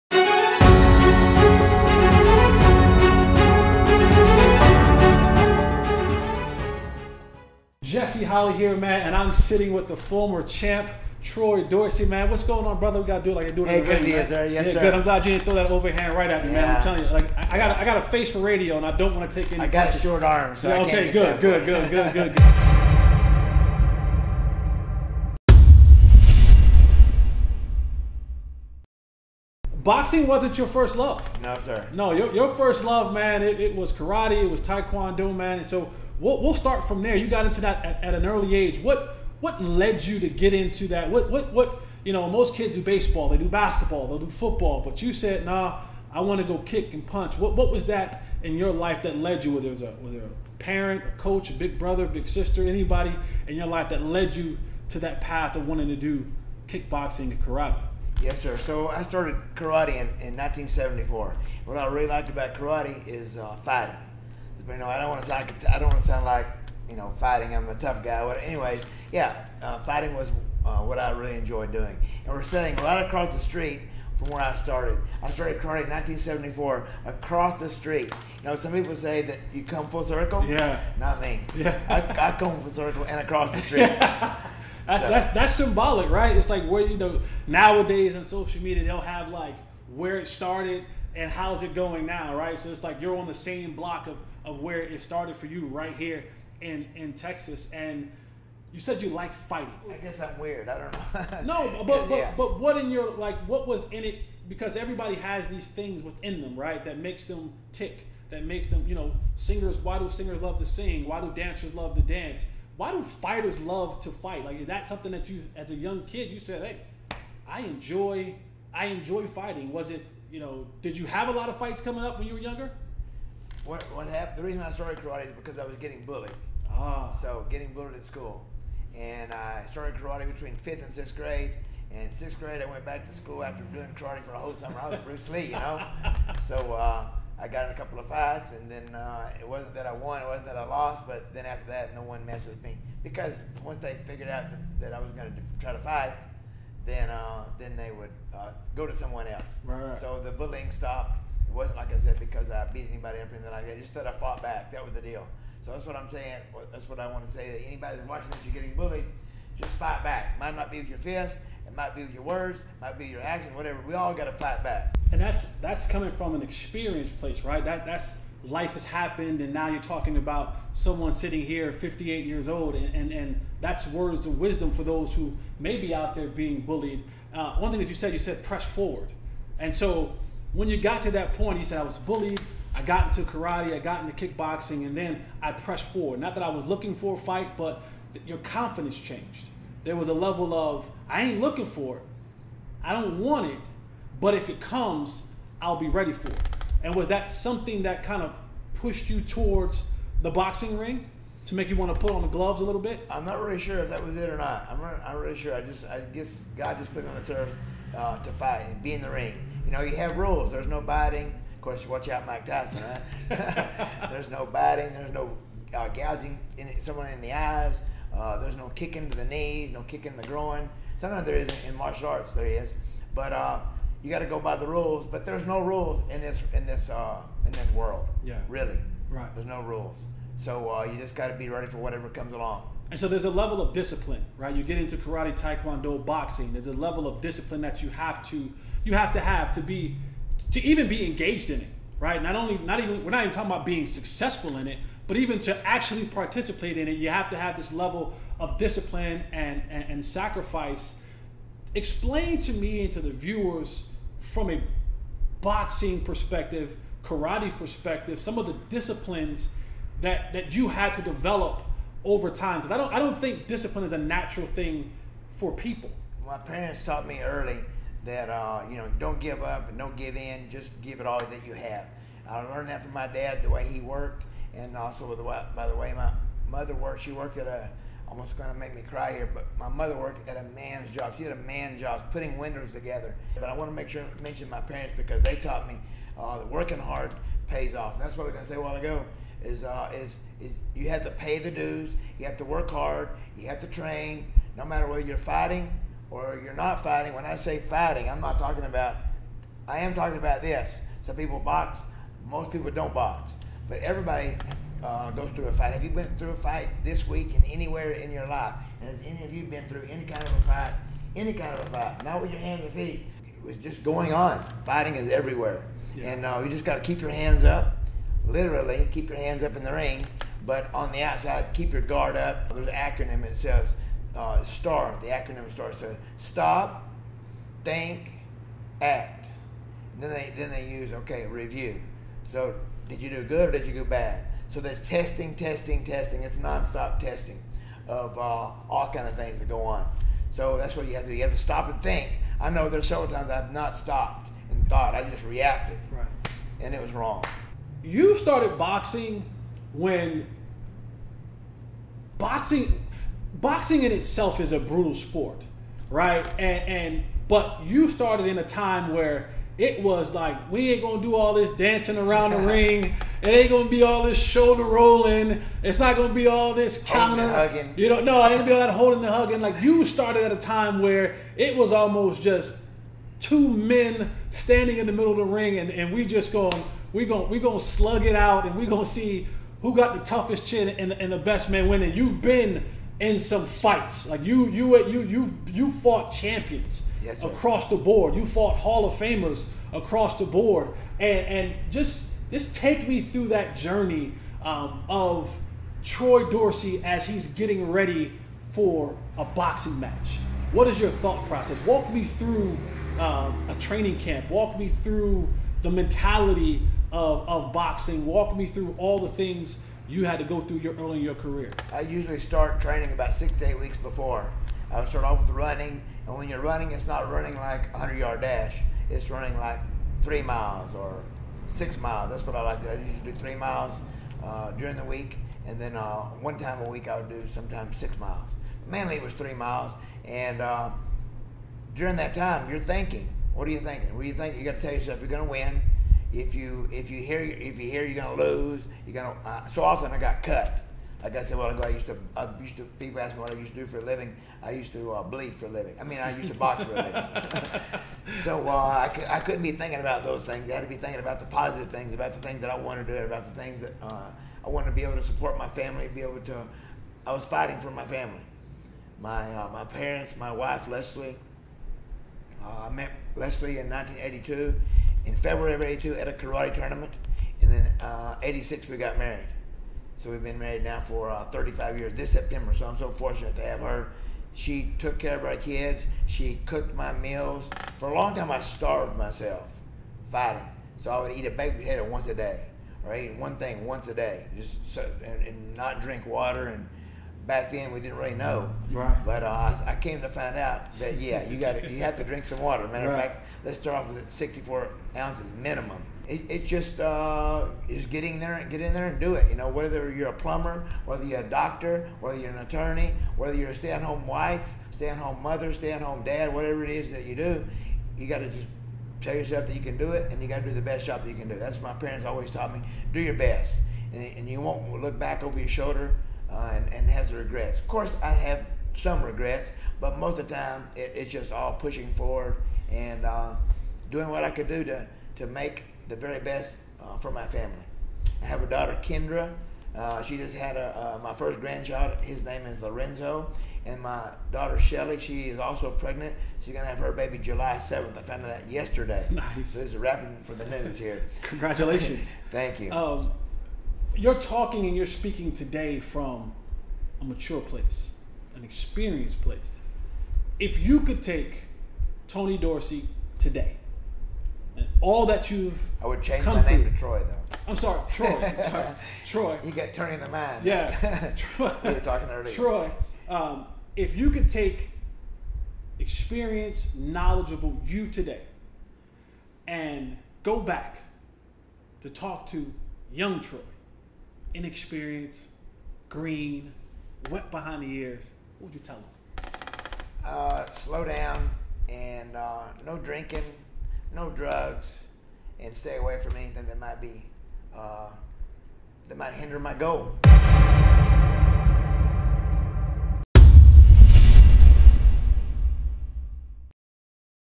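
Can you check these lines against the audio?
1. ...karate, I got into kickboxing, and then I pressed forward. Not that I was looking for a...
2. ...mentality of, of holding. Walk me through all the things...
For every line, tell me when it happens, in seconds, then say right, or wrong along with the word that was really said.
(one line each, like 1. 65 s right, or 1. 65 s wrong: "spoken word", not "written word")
1. 183 s right
2. 405 s wrong: "boxing", not "holding".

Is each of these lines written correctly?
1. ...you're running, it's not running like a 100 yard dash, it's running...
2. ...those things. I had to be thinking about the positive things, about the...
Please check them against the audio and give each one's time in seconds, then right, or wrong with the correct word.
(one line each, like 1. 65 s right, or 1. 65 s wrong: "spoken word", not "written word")
1. 416 s right
2. 450 s right.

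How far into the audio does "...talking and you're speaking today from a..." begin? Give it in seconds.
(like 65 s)
544 s.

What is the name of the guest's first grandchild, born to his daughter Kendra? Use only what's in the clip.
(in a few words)
Lorenzo.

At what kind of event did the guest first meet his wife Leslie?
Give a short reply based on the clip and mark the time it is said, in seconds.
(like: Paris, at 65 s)
Karate tournament, at 466 s.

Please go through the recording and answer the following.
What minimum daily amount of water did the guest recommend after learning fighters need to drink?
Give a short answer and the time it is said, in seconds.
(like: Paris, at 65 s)
64 ounces, at 494 s.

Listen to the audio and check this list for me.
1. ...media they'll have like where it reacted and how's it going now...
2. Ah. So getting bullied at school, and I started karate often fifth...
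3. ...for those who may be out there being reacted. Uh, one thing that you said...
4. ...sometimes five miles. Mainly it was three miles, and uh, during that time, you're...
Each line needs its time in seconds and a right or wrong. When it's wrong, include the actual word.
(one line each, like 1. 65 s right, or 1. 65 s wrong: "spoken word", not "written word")
1. 88 s wrong: "started", not "reacted"
2. 126 s wrong: "between", not "often"
3. 174 s wrong: "bullied", not "reacted"
4. 427 s wrong: "six", not "five".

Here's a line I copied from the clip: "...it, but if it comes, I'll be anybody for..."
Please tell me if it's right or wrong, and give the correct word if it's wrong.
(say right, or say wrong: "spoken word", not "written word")
wrong: "ready", not "anybody".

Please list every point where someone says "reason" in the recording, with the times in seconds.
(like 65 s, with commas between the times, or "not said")
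124 s.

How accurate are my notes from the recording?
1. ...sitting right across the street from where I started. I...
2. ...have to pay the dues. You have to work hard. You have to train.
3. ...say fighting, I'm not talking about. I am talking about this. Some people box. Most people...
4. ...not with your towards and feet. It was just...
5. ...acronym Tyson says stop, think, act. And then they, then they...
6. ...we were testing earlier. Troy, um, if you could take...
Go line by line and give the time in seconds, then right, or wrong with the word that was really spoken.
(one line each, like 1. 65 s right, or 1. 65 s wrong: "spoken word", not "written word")
1. 72 s right
2. 290 s right
3. 297 s right
4. 312 s wrong: "hands", not "towards"
5. 325 s wrong: "STAR", not "Tyson"
6. 561 s wrong: "talking", not "testing".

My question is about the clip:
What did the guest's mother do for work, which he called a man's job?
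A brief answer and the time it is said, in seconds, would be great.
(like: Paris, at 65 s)
Putting windows together, at 282 s.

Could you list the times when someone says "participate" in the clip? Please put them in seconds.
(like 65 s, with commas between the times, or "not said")
246 s.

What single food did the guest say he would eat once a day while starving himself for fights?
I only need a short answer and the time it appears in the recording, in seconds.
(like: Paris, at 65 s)
Baked potato, at 481 s.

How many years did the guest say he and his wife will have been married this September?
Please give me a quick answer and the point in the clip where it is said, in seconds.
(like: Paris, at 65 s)
35, at 471 s.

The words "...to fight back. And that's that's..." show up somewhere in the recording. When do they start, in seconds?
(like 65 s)
164 s.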